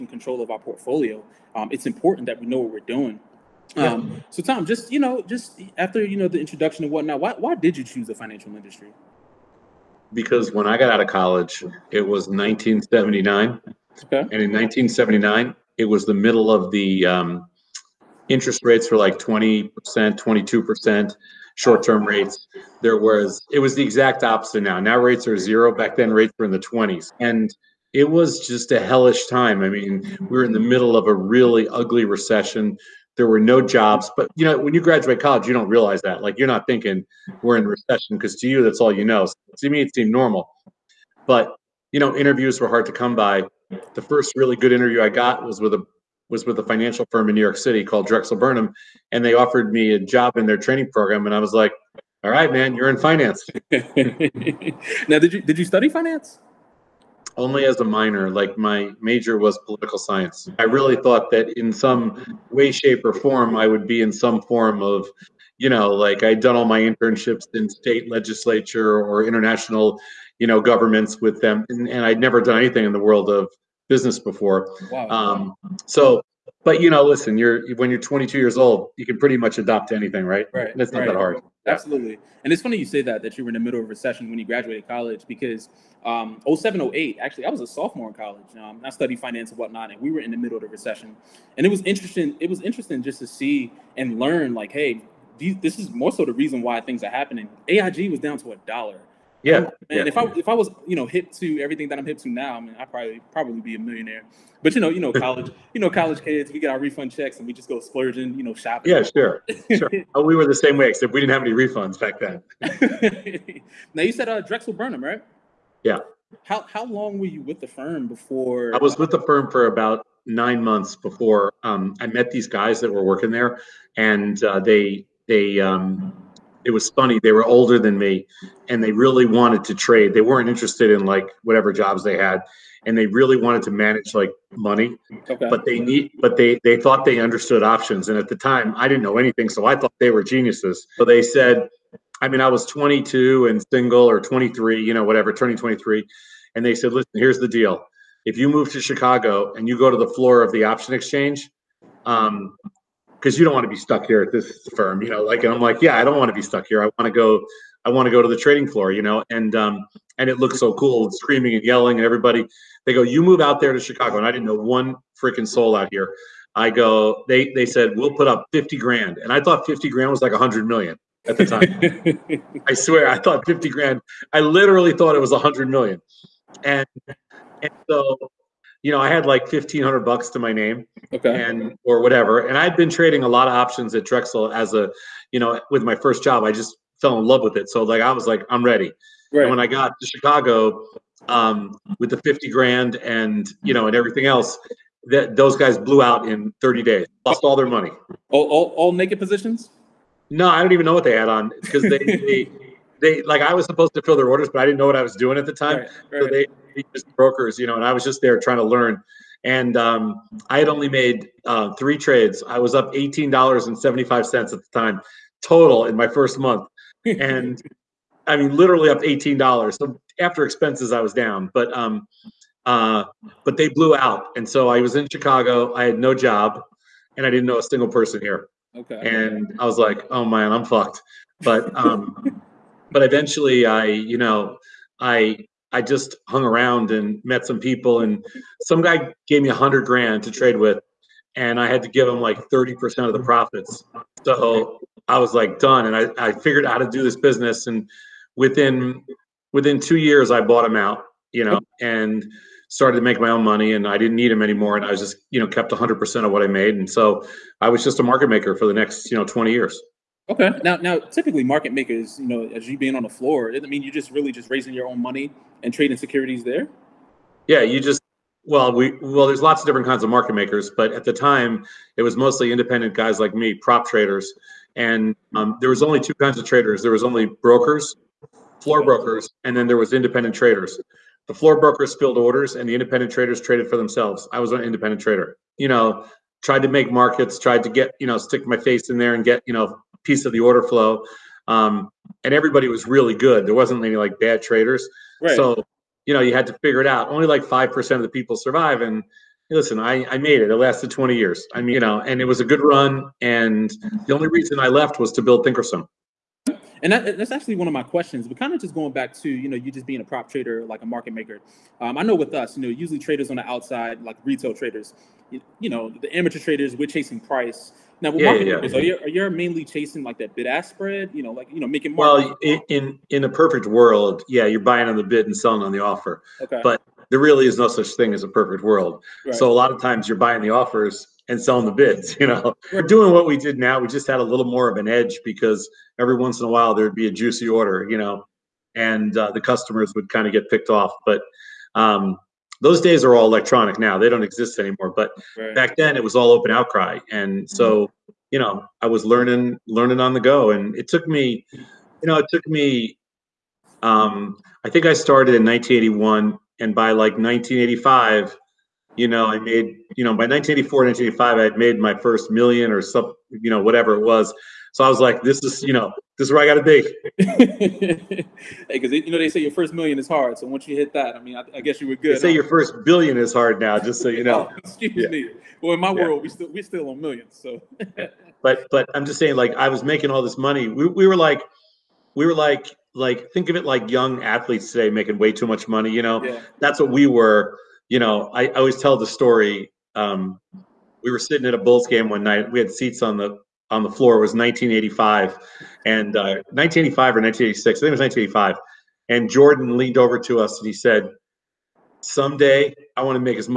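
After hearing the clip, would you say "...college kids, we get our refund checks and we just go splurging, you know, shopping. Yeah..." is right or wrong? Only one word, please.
right.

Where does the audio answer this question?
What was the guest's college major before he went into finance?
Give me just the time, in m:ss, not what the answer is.
0:59.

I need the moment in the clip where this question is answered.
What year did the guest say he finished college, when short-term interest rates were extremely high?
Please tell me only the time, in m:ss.
0:11.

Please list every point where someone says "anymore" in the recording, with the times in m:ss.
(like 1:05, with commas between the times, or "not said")
4:14, 5:44.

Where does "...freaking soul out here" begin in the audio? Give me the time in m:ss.
2:45.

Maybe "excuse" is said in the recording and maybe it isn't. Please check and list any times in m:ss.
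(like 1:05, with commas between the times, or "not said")
6:14.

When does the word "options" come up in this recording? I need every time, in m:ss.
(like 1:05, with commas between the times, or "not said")
2:17, 2:30, 3:03.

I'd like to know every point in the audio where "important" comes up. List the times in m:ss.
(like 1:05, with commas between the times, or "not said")
0:01.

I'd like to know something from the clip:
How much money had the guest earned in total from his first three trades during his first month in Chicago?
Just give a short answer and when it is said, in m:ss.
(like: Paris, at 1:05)
$18.75, at 3:32.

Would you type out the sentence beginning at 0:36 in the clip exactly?
Like you're not thinking we're in recession because to you that's all you know.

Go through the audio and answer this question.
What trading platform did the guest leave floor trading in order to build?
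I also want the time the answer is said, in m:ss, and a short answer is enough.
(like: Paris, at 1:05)
Thinkorswim, at 5:05.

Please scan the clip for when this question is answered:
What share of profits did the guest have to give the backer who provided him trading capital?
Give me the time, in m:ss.
4:02.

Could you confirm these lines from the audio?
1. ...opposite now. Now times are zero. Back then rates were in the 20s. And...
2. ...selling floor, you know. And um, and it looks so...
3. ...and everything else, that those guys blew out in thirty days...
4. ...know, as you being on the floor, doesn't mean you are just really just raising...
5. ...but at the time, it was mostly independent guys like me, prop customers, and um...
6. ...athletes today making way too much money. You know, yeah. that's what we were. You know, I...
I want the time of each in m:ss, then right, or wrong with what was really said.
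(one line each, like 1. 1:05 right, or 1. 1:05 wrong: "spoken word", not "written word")
1. 0:24 wrong: "rates", not "times"
2. 2:38 wrong: "trading", not "selling"
3. 3:13 right
4. 4:22 right
5. 4:30 wrong: "traders", not "customers"
6. 6:24 right.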